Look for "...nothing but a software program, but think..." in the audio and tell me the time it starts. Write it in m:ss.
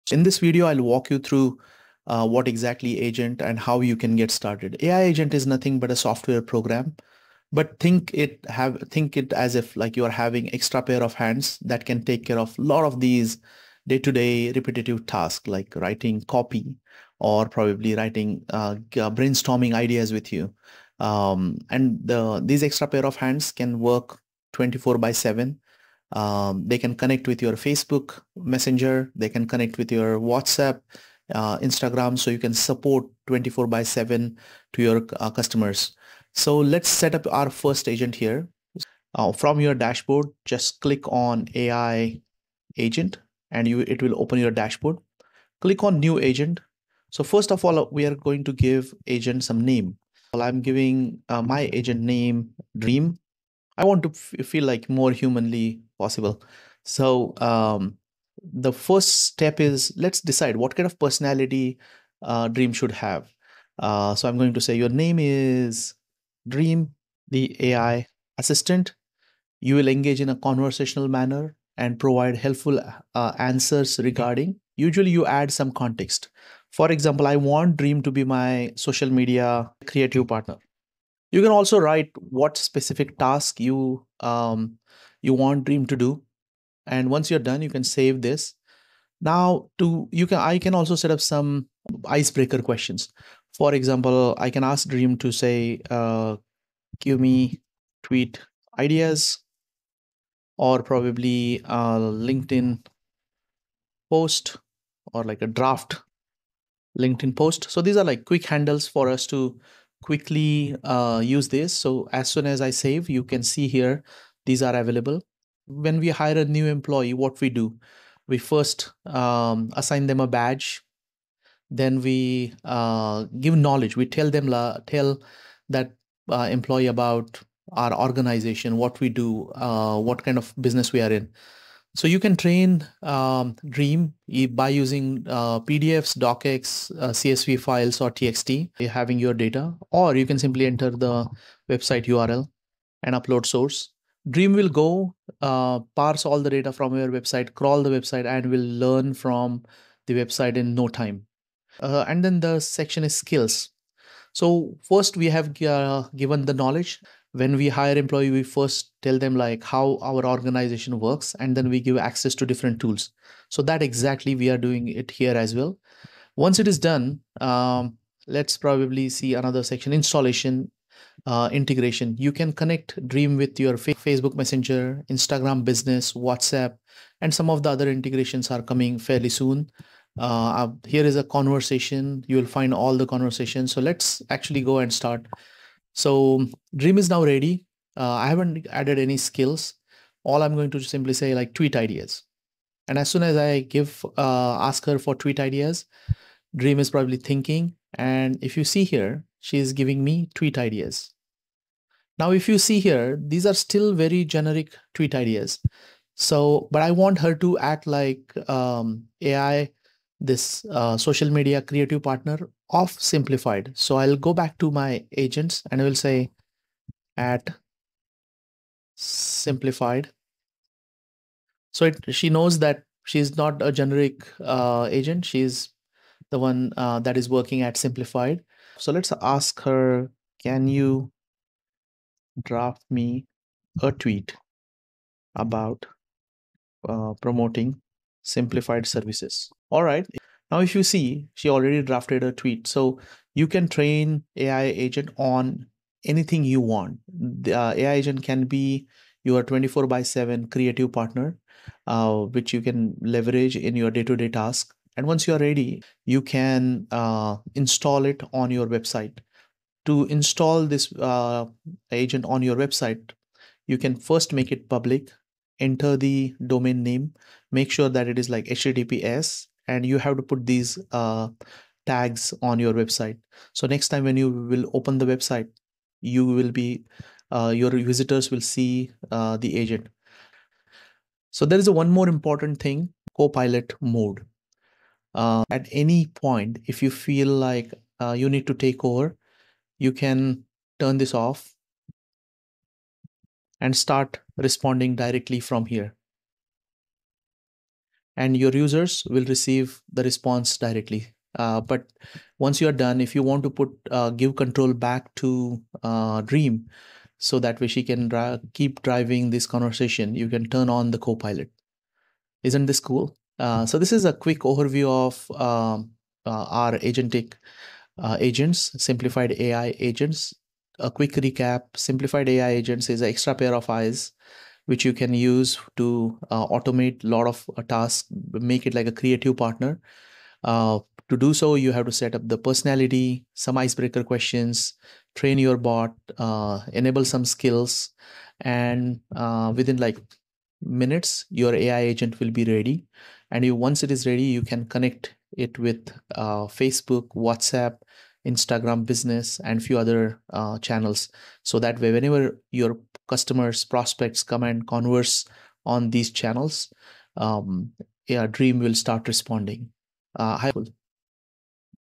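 0:05.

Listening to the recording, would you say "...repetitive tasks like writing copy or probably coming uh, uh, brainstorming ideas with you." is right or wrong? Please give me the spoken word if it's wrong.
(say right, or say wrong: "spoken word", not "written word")
wrong: "writing", not "coming".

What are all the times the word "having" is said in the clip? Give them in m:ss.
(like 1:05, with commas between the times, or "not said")
0:10, 2:18.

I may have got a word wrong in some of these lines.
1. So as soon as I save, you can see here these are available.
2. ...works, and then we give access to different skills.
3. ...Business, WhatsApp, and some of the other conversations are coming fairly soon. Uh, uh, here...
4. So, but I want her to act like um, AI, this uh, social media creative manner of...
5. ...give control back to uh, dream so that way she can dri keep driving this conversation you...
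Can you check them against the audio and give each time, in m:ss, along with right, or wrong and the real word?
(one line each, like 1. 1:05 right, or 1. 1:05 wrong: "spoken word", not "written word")
1. 1:51 right
2. 2:40 wrong: "tools", not "skills"
3. 2:55 wrong: "integrations", not "conversations"
4. 3:26 wrong: "partner", not "manner"
5. 5:04 right.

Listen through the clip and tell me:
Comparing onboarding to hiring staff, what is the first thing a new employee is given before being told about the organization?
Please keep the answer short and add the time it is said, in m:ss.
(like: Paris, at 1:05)
a badge, at 2:00.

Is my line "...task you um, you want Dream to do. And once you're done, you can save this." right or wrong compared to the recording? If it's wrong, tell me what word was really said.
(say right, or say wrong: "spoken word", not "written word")
right.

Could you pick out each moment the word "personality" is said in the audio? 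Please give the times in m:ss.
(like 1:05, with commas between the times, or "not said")
1:01, 5:32.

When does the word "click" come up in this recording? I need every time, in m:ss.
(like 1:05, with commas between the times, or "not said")
0:40, 0:45.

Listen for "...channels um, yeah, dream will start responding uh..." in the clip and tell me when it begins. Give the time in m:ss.
5:56.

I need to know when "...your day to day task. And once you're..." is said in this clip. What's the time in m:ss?
4:13.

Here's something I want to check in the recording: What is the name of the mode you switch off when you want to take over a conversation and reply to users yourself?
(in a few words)
Copilot mode.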